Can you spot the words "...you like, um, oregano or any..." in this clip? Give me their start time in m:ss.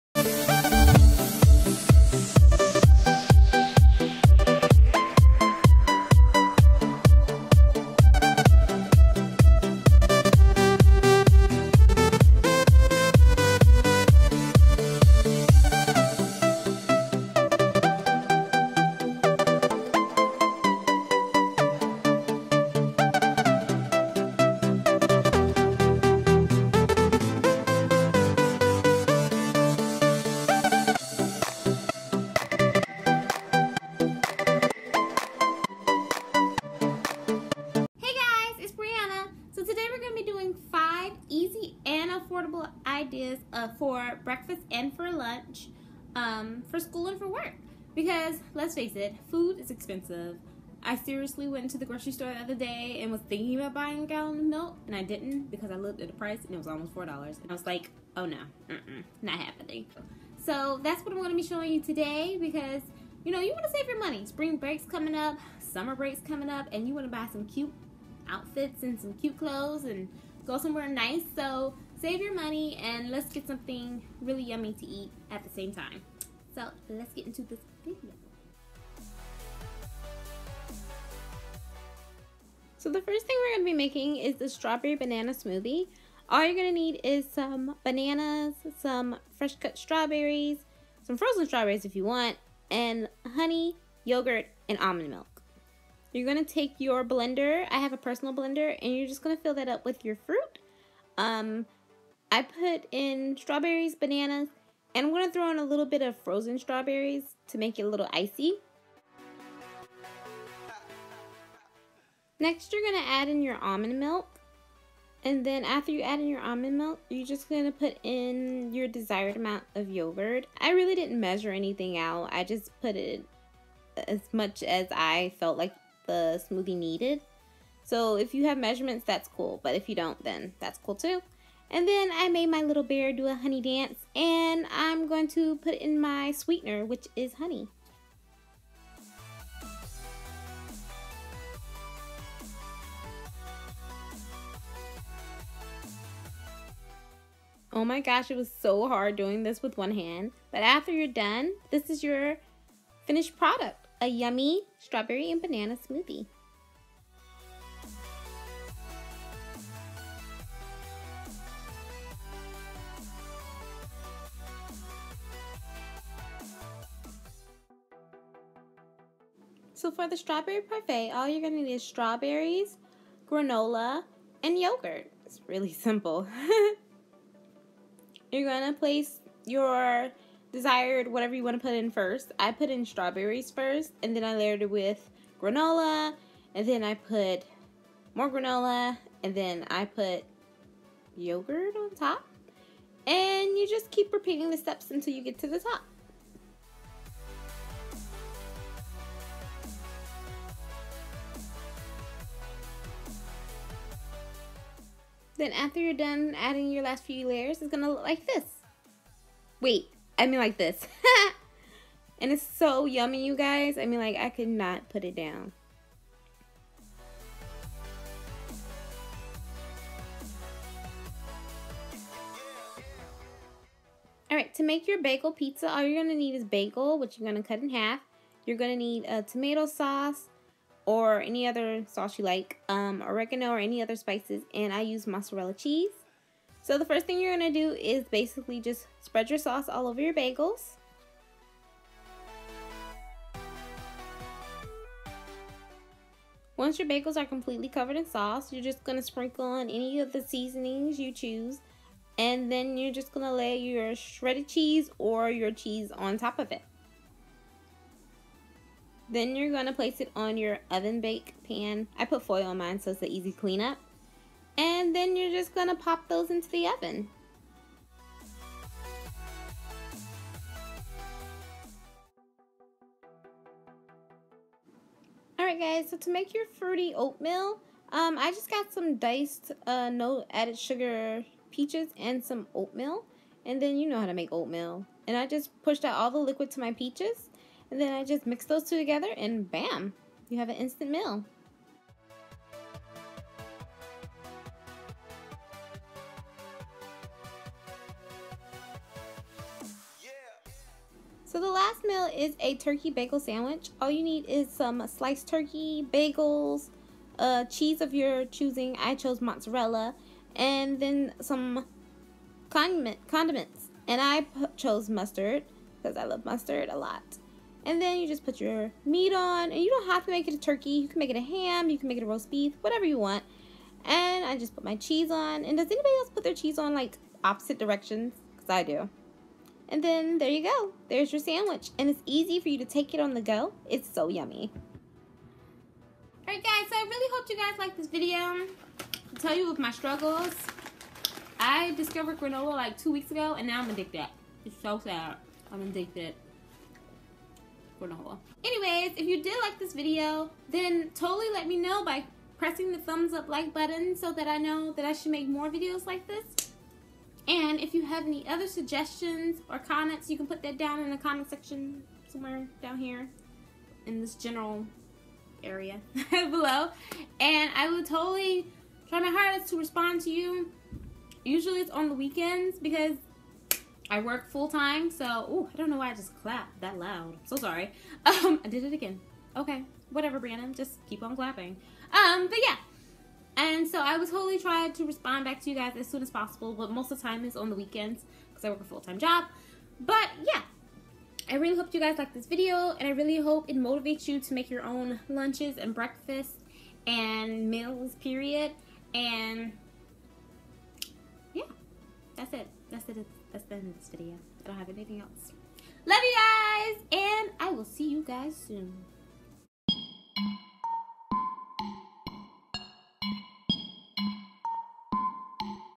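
3:52.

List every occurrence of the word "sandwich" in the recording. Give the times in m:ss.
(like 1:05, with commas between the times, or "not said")
5:03, 5:31.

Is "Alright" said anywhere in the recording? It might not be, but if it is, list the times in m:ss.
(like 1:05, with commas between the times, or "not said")
3:44, 4:35, 5:36.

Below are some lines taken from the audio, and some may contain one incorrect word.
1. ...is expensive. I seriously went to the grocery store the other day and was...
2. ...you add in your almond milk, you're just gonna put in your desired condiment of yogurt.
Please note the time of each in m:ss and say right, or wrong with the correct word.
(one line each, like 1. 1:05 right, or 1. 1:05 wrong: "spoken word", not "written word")
1. 0:49 right
2. 1:55 wrong: "amount", not "condiment".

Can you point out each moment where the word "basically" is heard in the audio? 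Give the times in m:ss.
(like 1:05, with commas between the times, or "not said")
3:58.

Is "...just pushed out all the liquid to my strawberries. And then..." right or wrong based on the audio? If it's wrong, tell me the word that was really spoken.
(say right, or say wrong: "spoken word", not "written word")
wrong: "peaches", not "strawberries".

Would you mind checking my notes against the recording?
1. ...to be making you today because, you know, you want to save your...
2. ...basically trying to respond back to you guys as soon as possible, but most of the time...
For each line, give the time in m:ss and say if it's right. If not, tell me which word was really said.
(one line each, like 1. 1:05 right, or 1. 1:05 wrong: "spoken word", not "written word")
1. 1:01 wrong: "showing", not "making"
2. 6:24 wrong: "totally", not "basically".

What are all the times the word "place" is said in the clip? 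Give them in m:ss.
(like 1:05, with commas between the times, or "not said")
2:58, 4:19.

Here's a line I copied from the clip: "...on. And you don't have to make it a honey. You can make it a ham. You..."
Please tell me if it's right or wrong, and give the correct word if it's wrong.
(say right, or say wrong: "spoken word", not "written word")
wrong: "turkey", not "honey".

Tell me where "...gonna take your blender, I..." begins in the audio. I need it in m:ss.
1:36.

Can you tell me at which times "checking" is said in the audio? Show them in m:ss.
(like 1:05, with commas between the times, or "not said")
not said.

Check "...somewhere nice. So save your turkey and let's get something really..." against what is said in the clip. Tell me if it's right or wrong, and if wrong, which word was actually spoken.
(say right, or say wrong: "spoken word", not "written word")
wrong: "money", not "turkey".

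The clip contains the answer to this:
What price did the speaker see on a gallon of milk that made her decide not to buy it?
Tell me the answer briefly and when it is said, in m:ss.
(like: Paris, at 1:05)
almost $4, at 0:56.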